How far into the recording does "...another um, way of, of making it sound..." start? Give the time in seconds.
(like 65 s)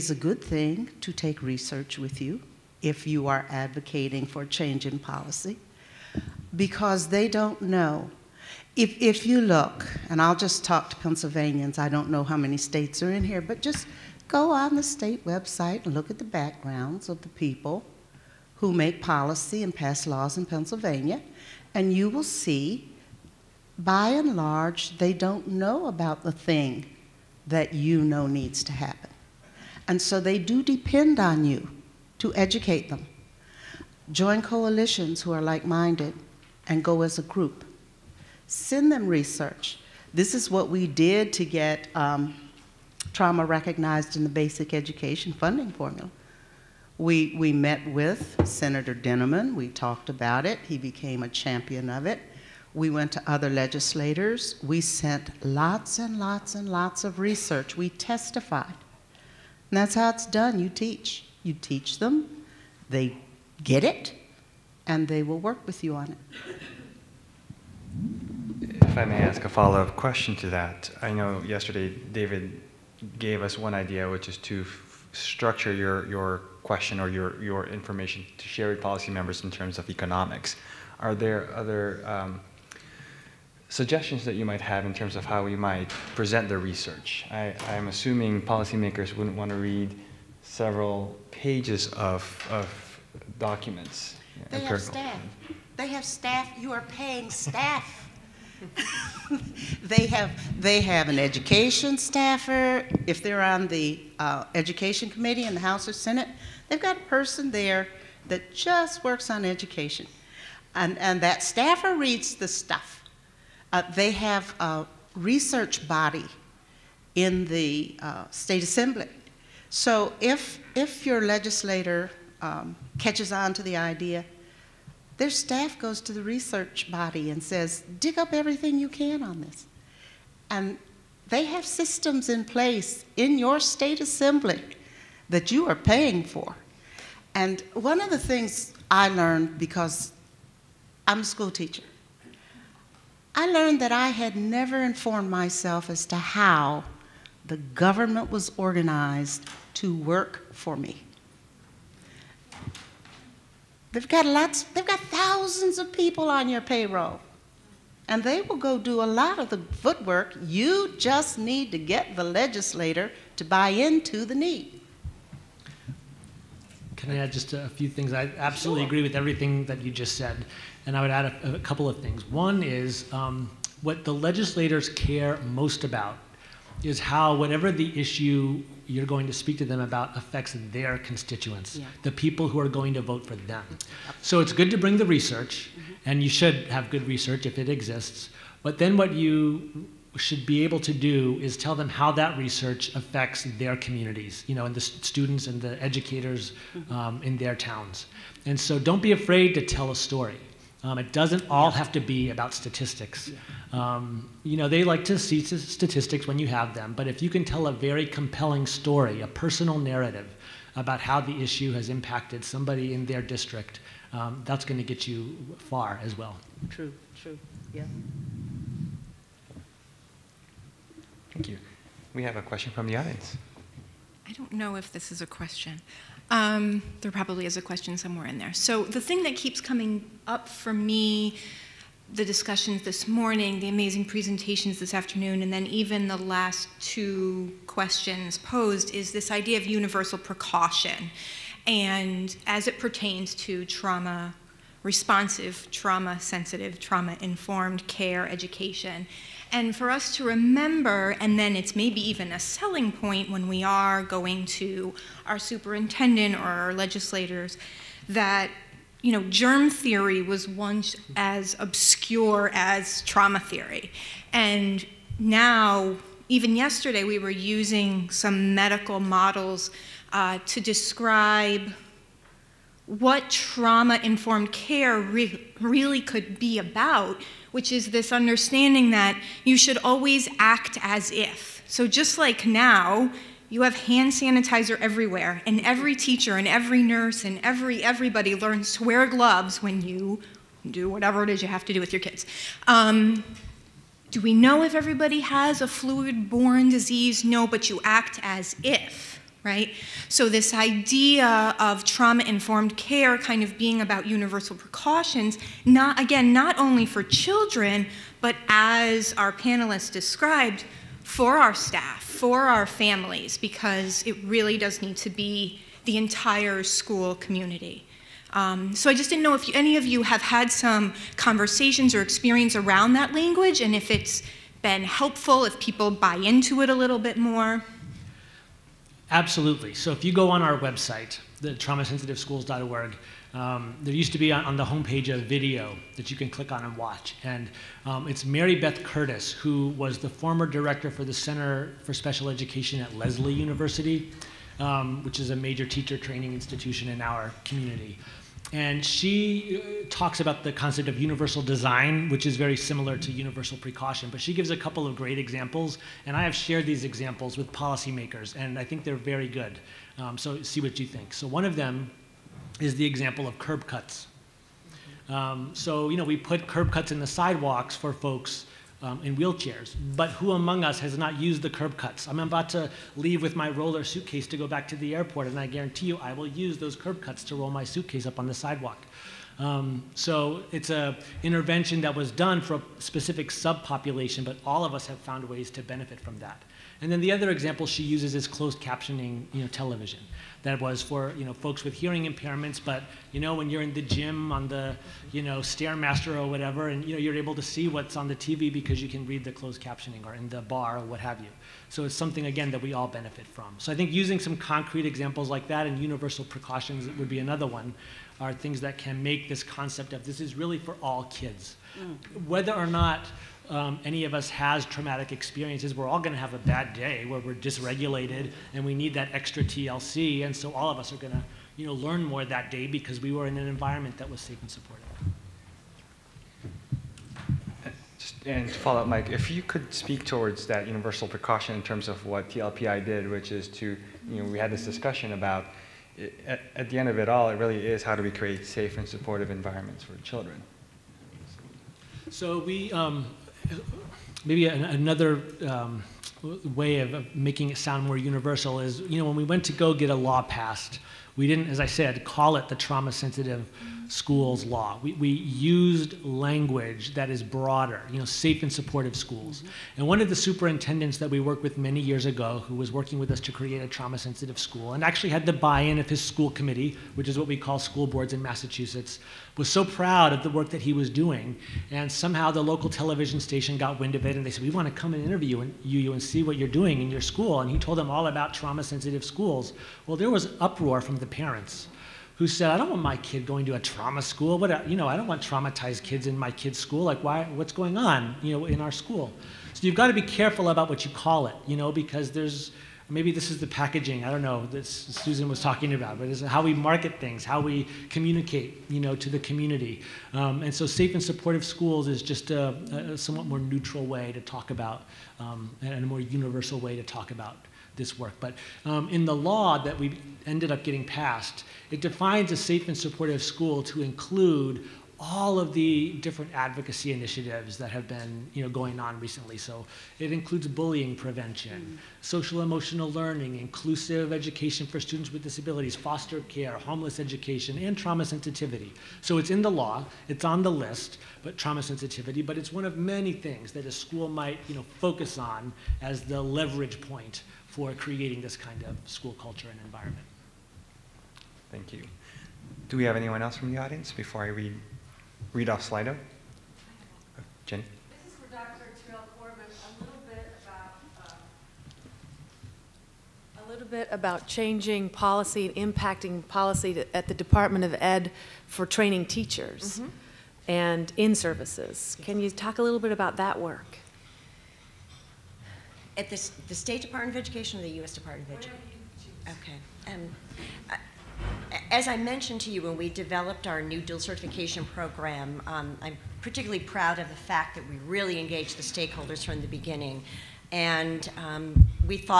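444 s.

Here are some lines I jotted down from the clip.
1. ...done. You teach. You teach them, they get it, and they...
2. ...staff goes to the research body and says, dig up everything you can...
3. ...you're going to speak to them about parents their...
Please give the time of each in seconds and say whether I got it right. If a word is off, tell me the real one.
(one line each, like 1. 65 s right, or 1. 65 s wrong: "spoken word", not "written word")
1. 60 s right
2. 125 s right
3. 178 s wrong: "affects", not "parents".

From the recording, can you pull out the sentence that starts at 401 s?
So it's something again that we all benefit from.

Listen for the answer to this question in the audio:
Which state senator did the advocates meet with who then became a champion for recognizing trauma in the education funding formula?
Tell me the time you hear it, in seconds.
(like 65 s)
48 s.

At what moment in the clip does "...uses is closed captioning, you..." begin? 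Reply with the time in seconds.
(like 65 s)
387 s.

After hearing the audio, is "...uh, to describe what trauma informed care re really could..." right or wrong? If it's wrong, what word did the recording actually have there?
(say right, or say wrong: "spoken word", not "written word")
right.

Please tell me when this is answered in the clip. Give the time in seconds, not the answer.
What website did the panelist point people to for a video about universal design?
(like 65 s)
331 s.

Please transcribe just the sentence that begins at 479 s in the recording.
Well, there was uproar from the parents who said, I don't want my kid going to a trauma school.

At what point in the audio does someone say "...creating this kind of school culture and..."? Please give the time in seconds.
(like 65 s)
537 s.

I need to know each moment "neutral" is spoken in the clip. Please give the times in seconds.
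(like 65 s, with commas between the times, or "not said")
503 s.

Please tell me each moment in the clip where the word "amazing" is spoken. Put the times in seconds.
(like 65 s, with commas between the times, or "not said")
233 s.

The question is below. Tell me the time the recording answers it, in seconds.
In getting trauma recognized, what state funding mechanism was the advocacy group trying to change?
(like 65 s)
44 s.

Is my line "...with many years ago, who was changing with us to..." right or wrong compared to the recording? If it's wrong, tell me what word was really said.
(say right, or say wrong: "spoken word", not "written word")
wrong: "working", not "changing".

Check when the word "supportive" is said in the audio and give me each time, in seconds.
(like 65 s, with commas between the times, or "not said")
424 s, 438 s, 458 s, 501 s, 512 s.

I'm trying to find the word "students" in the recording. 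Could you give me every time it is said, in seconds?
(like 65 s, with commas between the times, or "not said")
195 s, 524 s.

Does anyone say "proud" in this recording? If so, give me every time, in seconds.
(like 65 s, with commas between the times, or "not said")
469 s, 576 s.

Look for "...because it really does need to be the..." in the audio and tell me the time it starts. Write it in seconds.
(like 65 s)
313 s.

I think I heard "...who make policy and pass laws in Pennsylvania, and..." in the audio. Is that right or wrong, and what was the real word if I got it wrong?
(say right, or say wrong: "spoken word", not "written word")
right.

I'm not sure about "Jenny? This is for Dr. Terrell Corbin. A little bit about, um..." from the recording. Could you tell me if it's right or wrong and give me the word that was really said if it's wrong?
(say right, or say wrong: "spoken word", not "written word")
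right.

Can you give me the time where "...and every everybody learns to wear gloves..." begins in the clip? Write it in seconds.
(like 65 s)
287 s.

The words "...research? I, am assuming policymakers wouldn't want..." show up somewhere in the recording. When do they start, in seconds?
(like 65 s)
86 s.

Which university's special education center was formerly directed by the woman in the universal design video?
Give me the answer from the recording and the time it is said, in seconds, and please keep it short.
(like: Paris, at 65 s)
Lesley University, at 342 s.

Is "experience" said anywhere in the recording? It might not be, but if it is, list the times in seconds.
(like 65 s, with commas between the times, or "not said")
322 s, 415 s.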